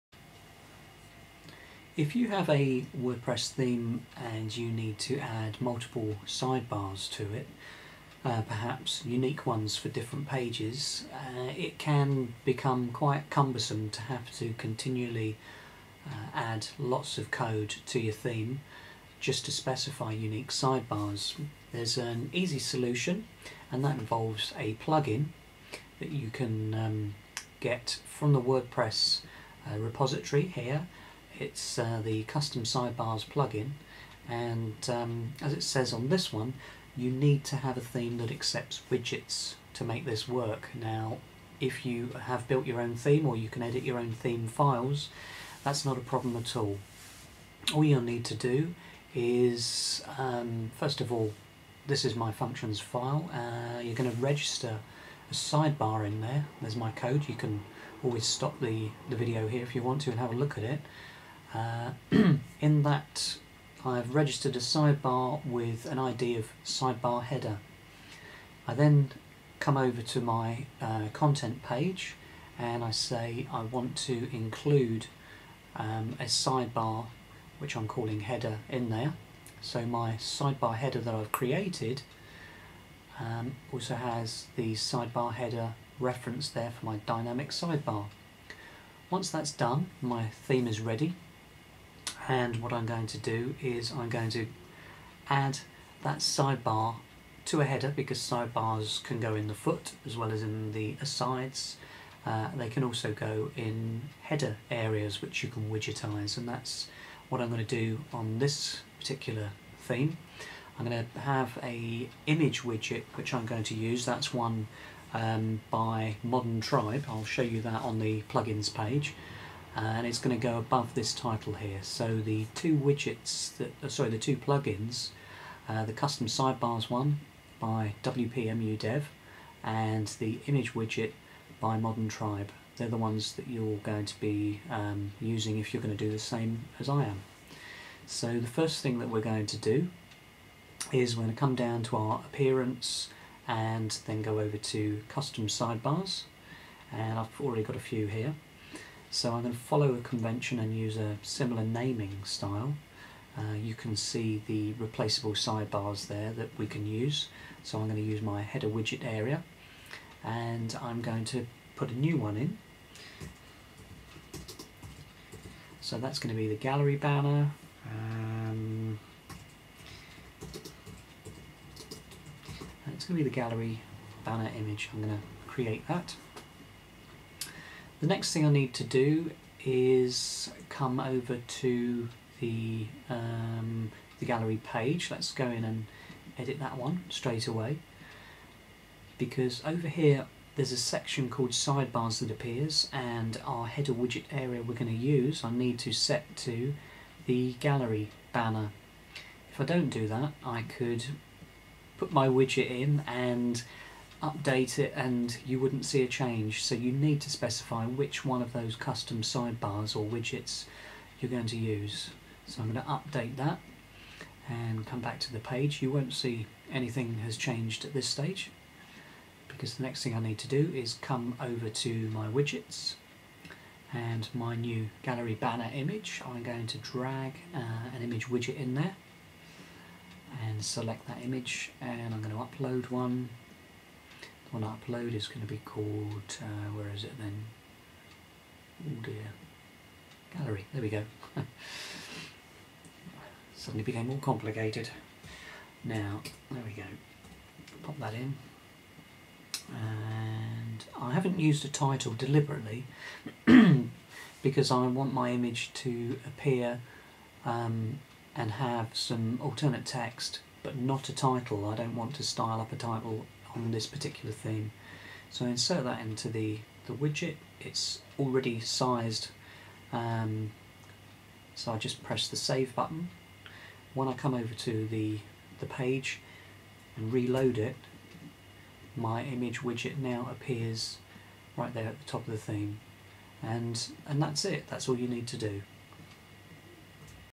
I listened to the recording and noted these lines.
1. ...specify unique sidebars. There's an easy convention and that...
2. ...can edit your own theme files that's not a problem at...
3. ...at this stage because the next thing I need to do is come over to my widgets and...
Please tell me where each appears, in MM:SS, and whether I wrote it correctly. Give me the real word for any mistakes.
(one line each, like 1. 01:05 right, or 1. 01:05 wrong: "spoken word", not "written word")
1. 00:19 wrong: "solution", not "convention"
2. 00:43 right
3. 03:37 right.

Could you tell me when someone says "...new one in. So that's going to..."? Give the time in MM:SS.
02:41.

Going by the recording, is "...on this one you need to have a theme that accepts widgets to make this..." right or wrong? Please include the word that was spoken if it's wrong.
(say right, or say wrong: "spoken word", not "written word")
right.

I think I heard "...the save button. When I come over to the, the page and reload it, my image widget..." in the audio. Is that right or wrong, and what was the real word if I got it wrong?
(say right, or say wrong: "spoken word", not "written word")
right.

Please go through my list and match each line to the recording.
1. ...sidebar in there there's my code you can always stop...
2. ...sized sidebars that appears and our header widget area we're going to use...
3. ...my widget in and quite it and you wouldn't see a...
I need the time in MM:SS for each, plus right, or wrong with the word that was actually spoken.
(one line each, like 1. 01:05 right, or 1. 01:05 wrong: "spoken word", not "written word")
1. 00:55 right
2. 03:11 wrong: "called", not "sized"
3. 03:22 wrong: "update", not "quite".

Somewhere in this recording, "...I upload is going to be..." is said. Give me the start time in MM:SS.
03:54.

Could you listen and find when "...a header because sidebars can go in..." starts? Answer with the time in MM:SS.
01:37.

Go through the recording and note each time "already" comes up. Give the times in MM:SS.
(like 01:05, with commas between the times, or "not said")
02:27, 04:28.